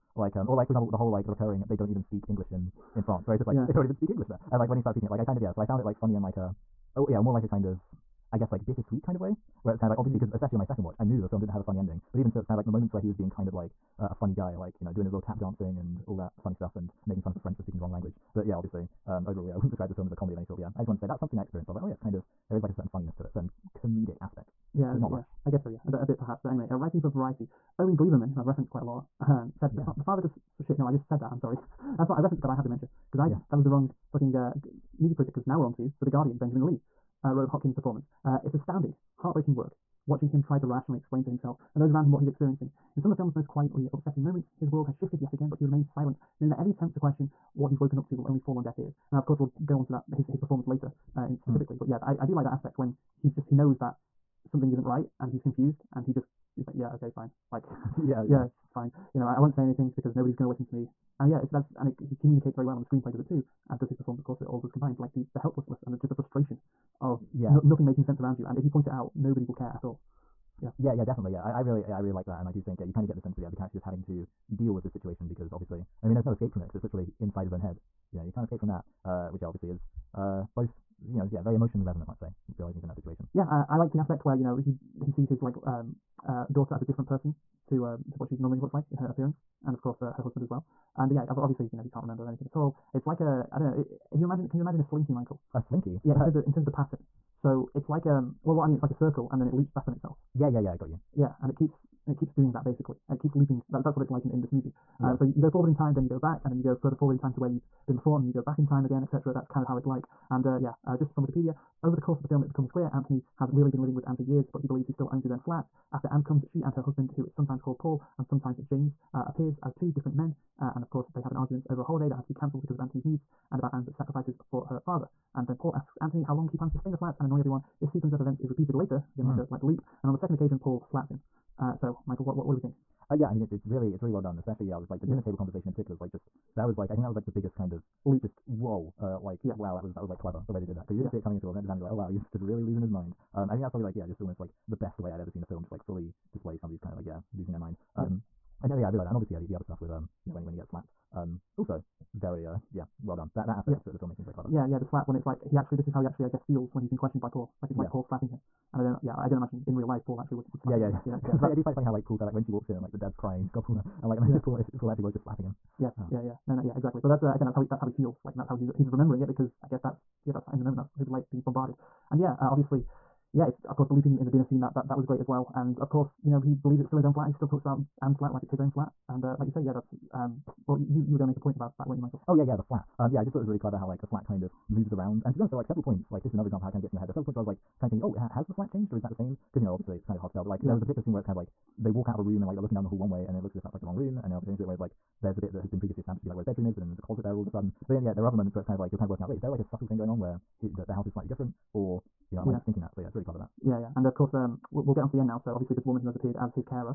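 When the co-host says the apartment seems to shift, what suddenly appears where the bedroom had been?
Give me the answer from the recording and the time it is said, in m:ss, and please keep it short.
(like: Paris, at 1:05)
A closet, at 3:16.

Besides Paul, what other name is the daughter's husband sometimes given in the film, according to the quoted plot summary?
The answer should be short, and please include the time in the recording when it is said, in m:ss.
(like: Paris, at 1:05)
James, at 1:58.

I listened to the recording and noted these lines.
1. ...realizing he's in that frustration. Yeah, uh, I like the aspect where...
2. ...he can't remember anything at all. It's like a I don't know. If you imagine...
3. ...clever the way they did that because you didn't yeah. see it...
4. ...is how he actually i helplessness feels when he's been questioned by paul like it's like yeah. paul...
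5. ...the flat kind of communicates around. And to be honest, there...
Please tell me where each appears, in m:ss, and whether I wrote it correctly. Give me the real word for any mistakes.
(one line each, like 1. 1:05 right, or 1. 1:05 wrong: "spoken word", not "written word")
1. 1:22 wrong: "situation", not "frustration"
2. 1:31 right
3. 2:20 right
4. 2:35 wrong: "guess", not "helplessness"
5. 3:04 wrong: "moves", not "communicates".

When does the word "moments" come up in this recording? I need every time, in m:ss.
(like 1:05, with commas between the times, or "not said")
0:12, 0:44, 2:50, 3:18.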